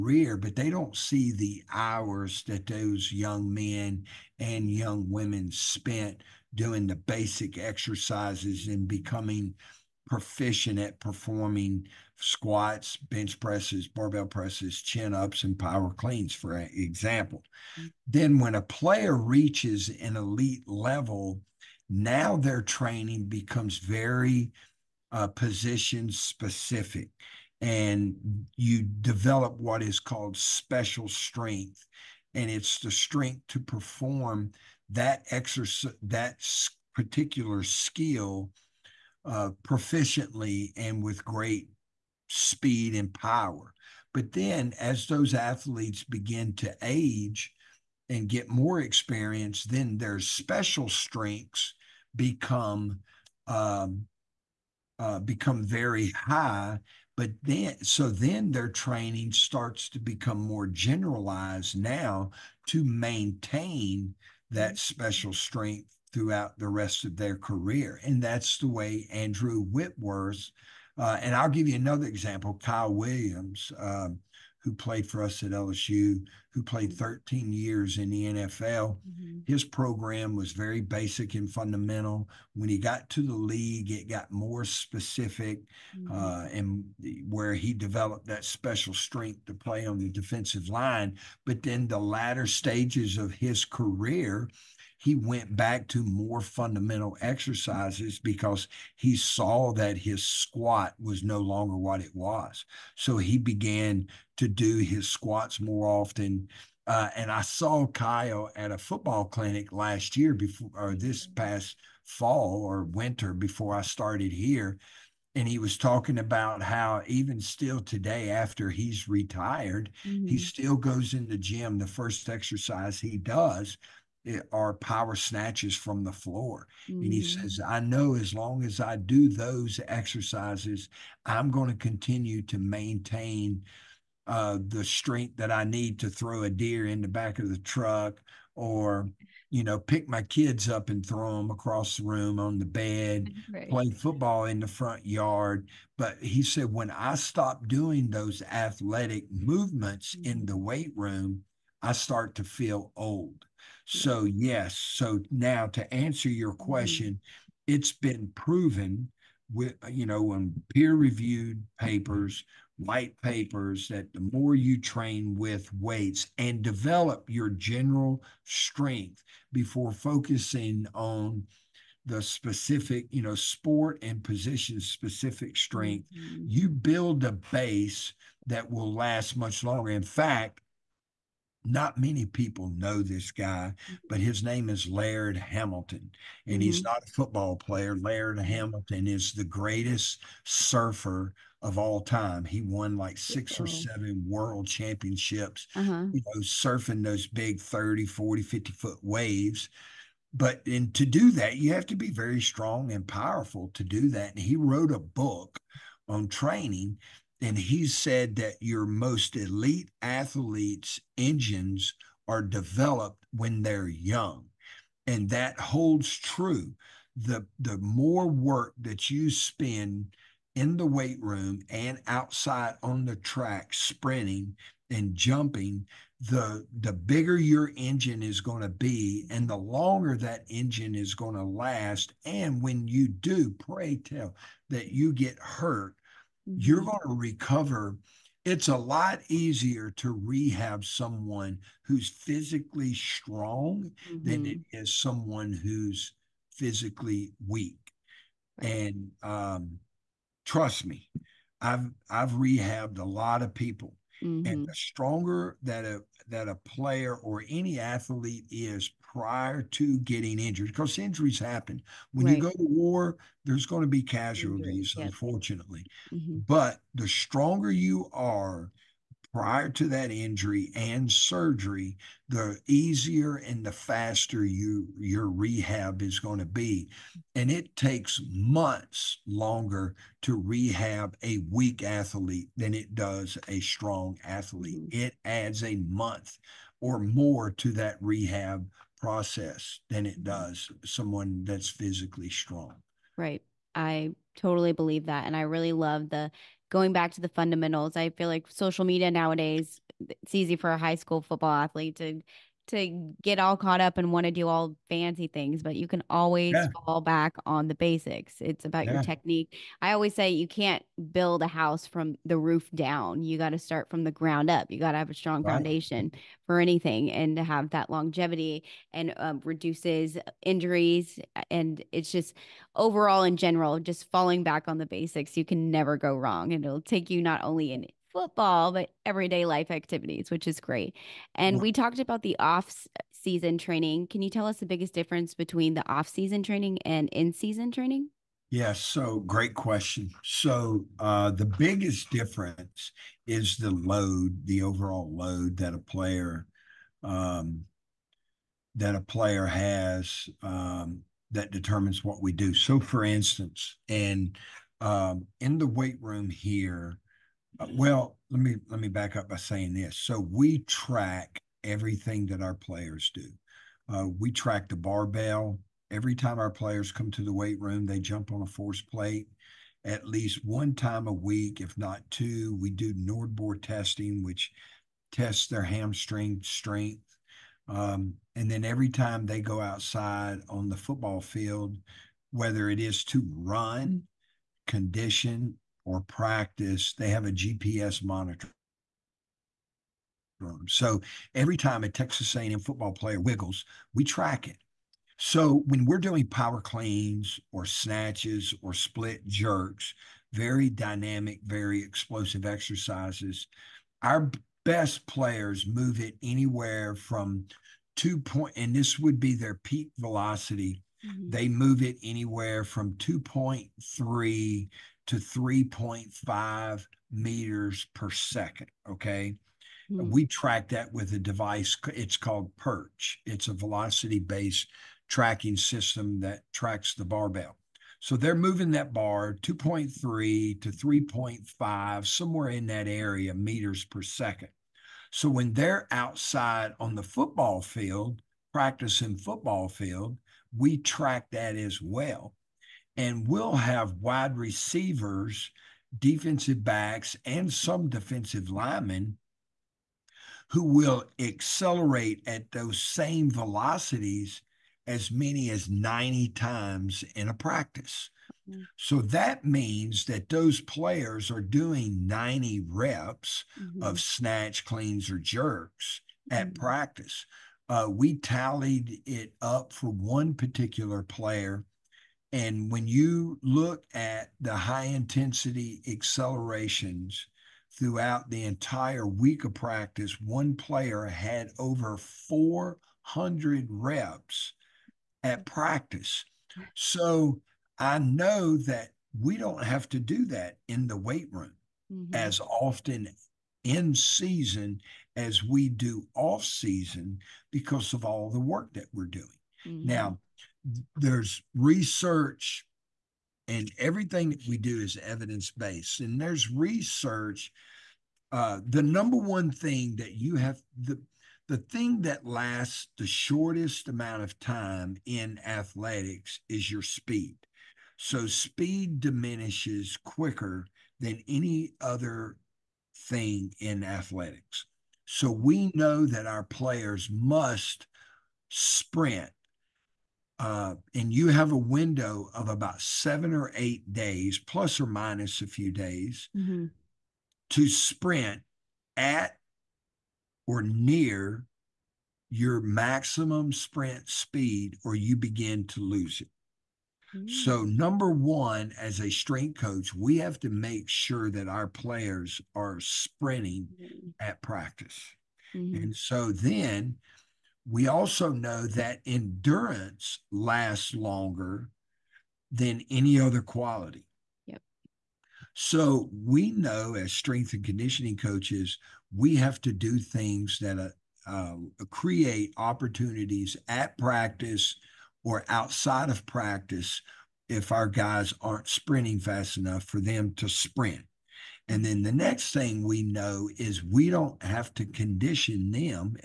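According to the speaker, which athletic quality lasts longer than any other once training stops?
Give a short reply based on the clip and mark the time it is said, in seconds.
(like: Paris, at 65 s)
Endurance, at 559 s.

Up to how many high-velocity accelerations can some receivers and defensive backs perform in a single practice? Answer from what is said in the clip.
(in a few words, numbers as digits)
90.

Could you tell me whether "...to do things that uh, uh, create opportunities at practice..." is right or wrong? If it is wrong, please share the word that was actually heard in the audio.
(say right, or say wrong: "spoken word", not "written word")
right.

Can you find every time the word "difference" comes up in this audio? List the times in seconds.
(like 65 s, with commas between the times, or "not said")
334 s, 342 s.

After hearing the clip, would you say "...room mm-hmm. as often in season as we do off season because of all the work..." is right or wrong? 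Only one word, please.
right.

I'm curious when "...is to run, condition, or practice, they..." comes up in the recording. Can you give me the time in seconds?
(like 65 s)
382 s.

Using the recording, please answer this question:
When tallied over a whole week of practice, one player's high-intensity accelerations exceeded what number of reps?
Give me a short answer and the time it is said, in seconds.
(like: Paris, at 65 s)
400, at 481 s.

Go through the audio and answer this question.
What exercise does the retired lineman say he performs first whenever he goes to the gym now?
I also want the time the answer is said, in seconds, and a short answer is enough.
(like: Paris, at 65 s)
Power snatches, at 124 s.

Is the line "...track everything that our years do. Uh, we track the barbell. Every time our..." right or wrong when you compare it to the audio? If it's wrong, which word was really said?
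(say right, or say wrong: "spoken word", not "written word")
wrong: "players", not "years".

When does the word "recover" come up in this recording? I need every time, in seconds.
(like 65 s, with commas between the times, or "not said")
237 s.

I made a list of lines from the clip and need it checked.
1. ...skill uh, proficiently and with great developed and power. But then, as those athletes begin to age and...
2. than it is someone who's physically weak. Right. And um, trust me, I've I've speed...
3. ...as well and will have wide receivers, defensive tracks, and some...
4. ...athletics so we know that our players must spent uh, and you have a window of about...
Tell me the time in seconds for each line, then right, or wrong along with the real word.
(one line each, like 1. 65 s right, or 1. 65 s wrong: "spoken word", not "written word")
1. 37 s wrong: "speed", not "developed"
2. 244 s wrong: "rehabbed", not "speed"
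3. 441 s wrong: "backs", not "tracks"
4. 523 s wrong: "sprint", not "spent".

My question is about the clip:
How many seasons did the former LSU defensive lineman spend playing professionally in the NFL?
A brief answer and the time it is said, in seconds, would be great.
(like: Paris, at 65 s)
13, at 76 s.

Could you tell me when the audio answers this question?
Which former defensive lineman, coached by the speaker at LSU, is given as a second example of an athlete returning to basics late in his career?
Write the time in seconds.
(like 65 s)
72 s.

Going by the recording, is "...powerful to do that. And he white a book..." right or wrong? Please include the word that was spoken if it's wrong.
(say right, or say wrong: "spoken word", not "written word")
wrong: "wrote", not "white".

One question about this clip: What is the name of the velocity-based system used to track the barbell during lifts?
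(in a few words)
Perch.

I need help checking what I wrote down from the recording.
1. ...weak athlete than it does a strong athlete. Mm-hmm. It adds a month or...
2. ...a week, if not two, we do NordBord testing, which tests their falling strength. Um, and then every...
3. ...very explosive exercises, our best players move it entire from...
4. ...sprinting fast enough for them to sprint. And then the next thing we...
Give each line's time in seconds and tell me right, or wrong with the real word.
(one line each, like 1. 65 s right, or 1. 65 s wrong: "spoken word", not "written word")
1. 281 s right
2. 371 s wrong: "hamstring", not "falling"
3. 401 s wrong: "anywhere", not "entire"
4. 578 s right.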